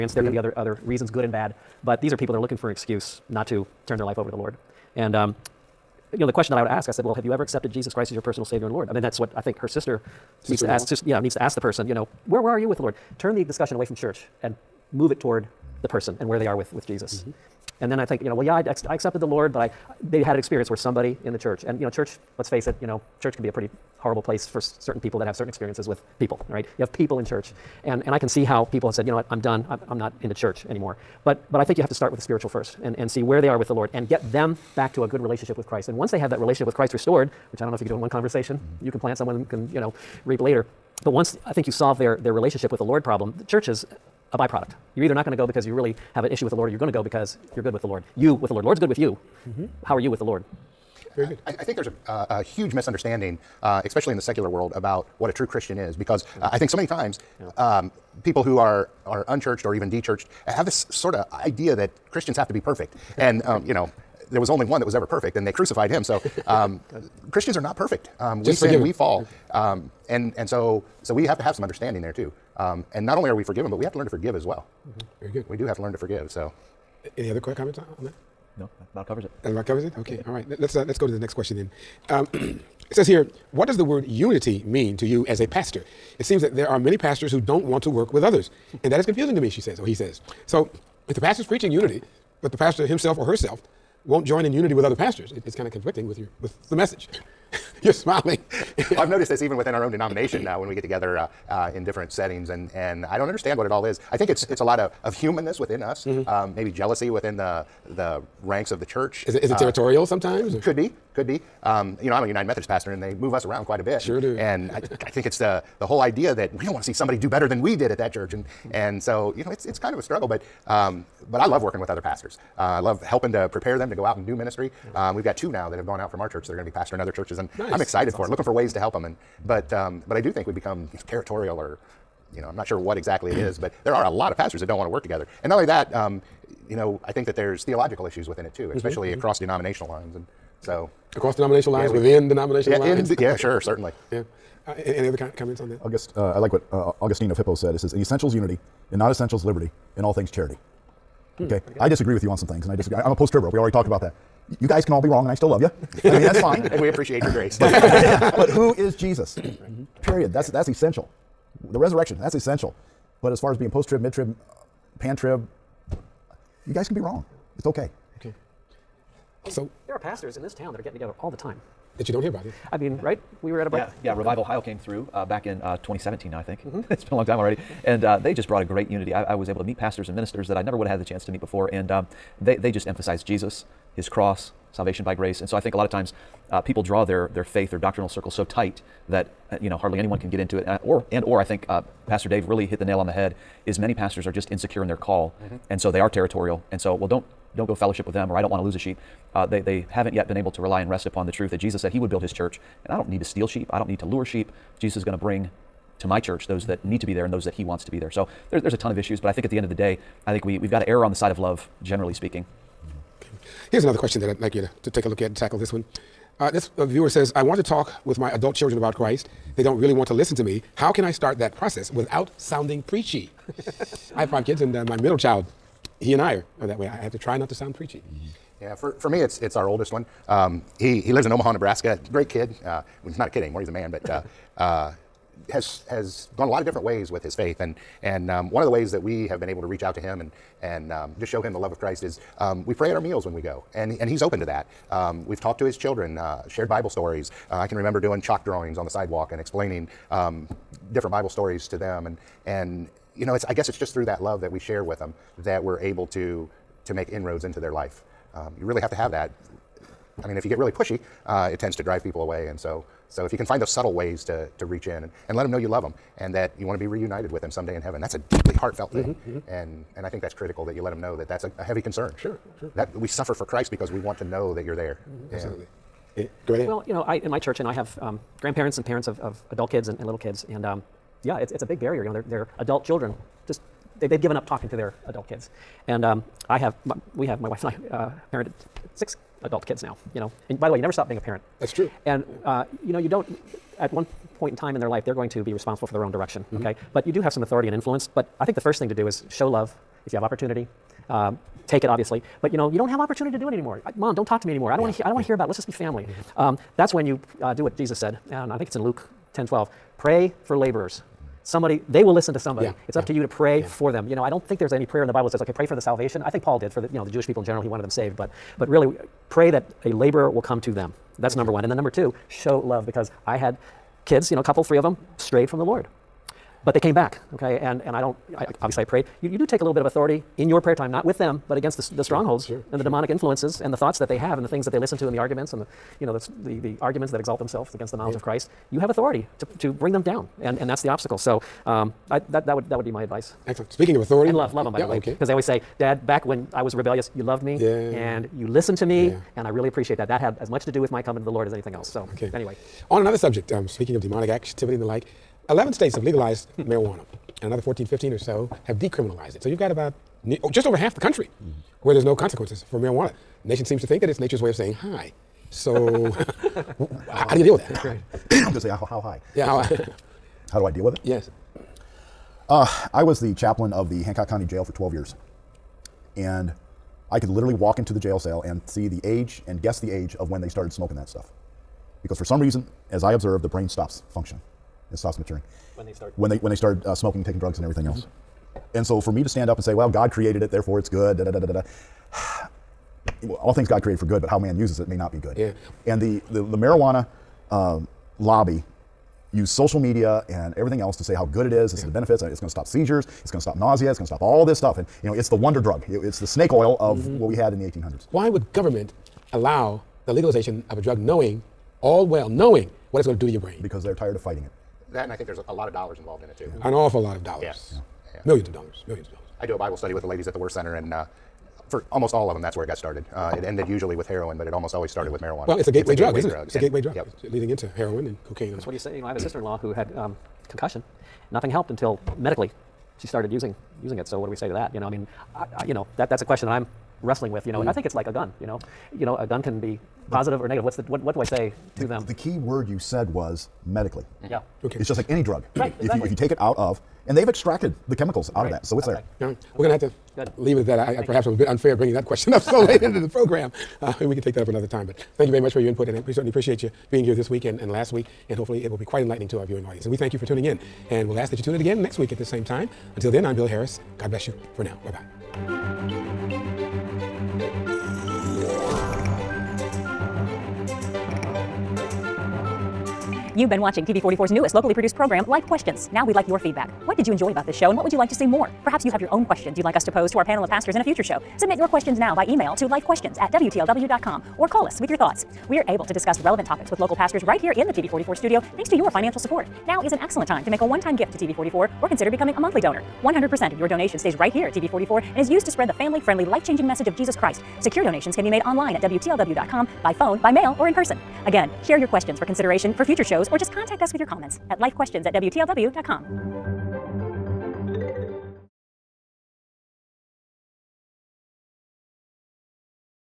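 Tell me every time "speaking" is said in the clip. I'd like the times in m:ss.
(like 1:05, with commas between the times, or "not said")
3:32, 5:43, 5:53.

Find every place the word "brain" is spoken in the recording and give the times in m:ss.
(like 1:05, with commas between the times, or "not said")
6:23, 6:53.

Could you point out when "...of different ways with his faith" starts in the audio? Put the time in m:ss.
3:56.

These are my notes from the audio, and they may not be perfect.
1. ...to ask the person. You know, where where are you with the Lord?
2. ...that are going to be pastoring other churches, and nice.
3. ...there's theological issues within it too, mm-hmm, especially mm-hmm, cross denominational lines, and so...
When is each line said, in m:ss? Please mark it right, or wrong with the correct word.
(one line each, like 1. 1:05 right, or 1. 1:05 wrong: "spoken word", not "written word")
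1. 0:11 right
2. 2:06 right
3. 2:17 wrong: "across", not "cross".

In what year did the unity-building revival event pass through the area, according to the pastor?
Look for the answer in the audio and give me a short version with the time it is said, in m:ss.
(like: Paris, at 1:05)
2017, at 2:55.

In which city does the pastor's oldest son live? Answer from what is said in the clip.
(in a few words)
Omaha, Nebraska.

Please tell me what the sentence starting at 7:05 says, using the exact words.
Well, it's a gateway, it's a drug, gateway isn't it?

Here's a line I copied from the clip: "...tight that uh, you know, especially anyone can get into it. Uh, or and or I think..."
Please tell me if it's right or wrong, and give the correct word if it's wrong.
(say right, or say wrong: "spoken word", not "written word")
wrong: "hardly", not "especially".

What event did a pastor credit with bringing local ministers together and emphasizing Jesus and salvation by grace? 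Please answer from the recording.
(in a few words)
Revive Ohio.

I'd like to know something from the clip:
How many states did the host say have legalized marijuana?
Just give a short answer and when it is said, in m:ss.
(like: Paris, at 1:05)
11, at 5:55.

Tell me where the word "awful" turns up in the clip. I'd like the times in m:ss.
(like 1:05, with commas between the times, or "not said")
6:56.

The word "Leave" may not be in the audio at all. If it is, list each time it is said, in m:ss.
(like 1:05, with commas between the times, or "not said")
7:30.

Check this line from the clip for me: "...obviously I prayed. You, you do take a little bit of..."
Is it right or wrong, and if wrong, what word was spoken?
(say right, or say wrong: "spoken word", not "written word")
right.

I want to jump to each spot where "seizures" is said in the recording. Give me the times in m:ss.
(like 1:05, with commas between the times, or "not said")
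6:42.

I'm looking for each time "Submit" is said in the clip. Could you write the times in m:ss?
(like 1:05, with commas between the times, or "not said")
8:01.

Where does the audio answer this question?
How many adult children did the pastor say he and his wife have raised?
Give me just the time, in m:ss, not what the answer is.
4:48.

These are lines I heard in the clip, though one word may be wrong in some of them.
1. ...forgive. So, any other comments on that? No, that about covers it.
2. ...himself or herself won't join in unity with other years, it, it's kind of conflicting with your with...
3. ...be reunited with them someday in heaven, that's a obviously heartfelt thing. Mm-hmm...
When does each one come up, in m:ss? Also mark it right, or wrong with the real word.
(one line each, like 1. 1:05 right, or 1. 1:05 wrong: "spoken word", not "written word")
1. 1:15 right
2. 1:32 wrong: "pastors", not "years"
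3. 4:26 wrong: "deeply", not "obviously".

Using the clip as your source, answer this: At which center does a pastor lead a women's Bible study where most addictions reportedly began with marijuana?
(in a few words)
WORTH Center.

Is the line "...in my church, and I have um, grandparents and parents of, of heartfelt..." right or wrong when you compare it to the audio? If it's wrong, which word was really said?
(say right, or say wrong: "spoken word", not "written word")
wrong: "adult", not "heartfelt".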